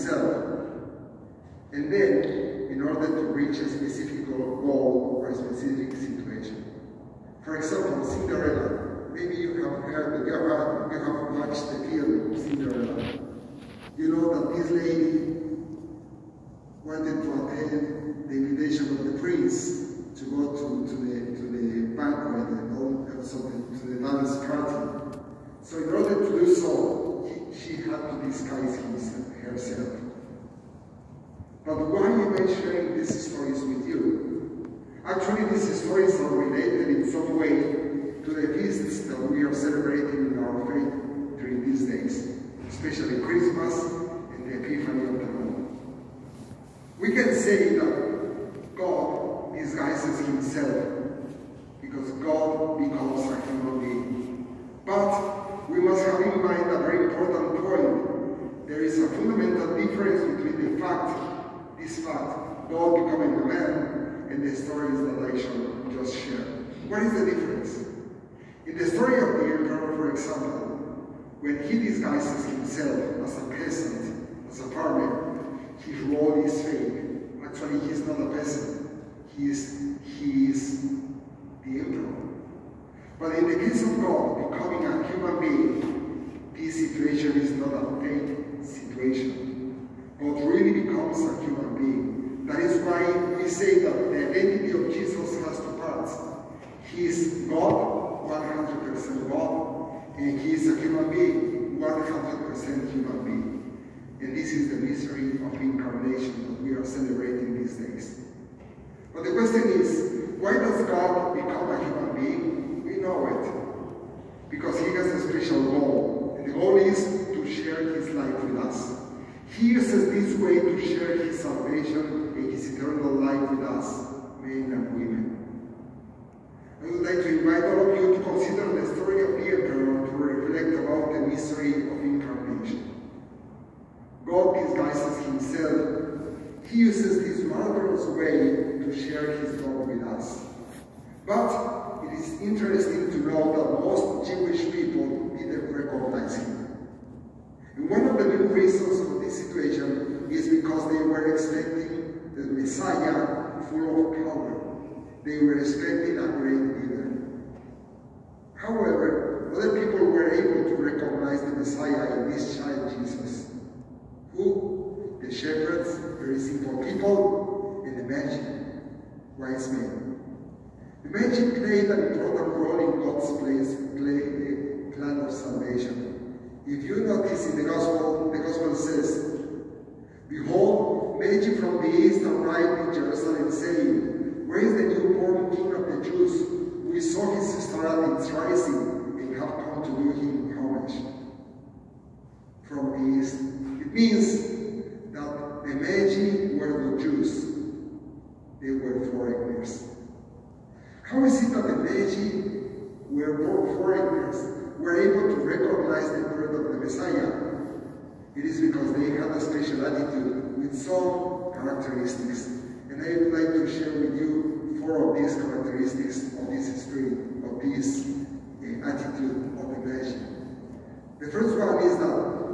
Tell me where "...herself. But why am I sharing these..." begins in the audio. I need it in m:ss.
0:29.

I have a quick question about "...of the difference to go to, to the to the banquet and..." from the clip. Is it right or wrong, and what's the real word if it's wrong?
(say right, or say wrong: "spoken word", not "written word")
wrong: "prince", not "difference".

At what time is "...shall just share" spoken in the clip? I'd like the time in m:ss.
1:05.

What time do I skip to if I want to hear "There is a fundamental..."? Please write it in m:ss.
0:58.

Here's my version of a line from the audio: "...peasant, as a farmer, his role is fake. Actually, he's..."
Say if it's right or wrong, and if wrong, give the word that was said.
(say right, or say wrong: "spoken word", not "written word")
right.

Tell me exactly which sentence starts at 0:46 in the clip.
We can say that himself because God becomes a human being.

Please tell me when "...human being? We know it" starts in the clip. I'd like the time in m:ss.
1:51.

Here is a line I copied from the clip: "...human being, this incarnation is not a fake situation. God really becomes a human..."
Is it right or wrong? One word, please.
wrong.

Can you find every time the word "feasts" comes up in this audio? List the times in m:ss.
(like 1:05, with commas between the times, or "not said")
0:38.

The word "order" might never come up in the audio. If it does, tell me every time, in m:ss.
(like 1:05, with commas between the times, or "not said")
0:02, 0:25.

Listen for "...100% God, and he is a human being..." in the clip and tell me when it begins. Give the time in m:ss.
1:38.